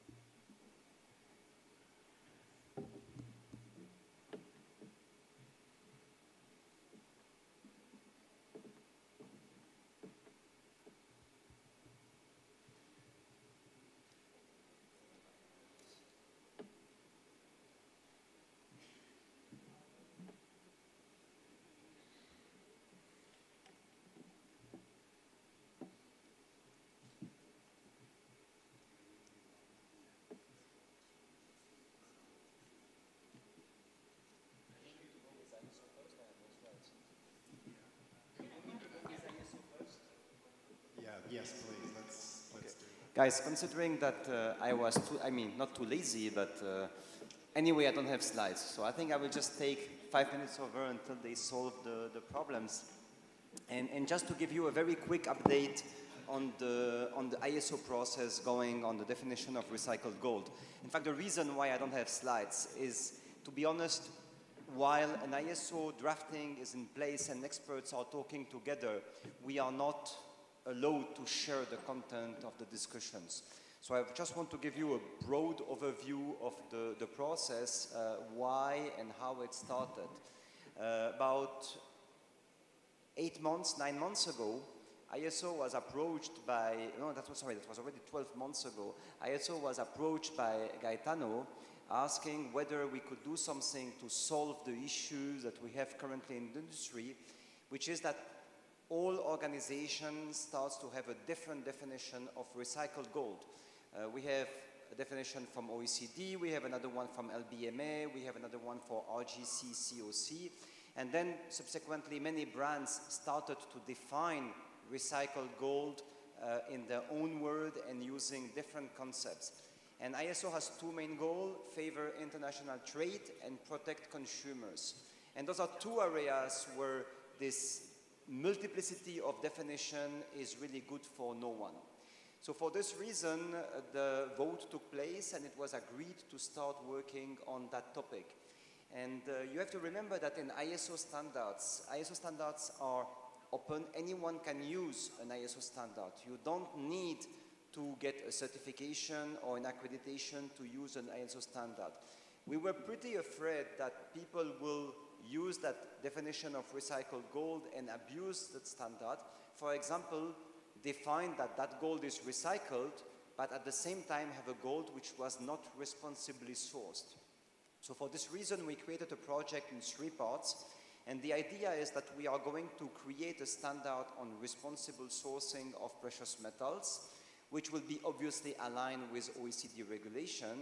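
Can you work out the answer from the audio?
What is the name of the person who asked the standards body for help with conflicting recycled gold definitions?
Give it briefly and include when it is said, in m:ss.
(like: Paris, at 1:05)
Gaetano, at 1:30.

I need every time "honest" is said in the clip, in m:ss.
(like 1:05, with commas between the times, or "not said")
1:03.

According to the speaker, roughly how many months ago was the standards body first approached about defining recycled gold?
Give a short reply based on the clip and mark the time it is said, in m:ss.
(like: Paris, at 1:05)
12 months, at 1:28.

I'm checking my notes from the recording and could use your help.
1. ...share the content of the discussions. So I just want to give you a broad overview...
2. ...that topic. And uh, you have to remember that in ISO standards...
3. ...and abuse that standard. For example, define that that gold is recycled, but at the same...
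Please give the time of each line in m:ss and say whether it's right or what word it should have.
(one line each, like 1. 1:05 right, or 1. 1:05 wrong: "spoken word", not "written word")
1. 1:11 right
2. 2:17 right
3. 2:37 right.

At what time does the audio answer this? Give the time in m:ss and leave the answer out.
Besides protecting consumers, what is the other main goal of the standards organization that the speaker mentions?
2:01.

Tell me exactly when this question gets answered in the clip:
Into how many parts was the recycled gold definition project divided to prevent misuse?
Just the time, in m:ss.
2:49.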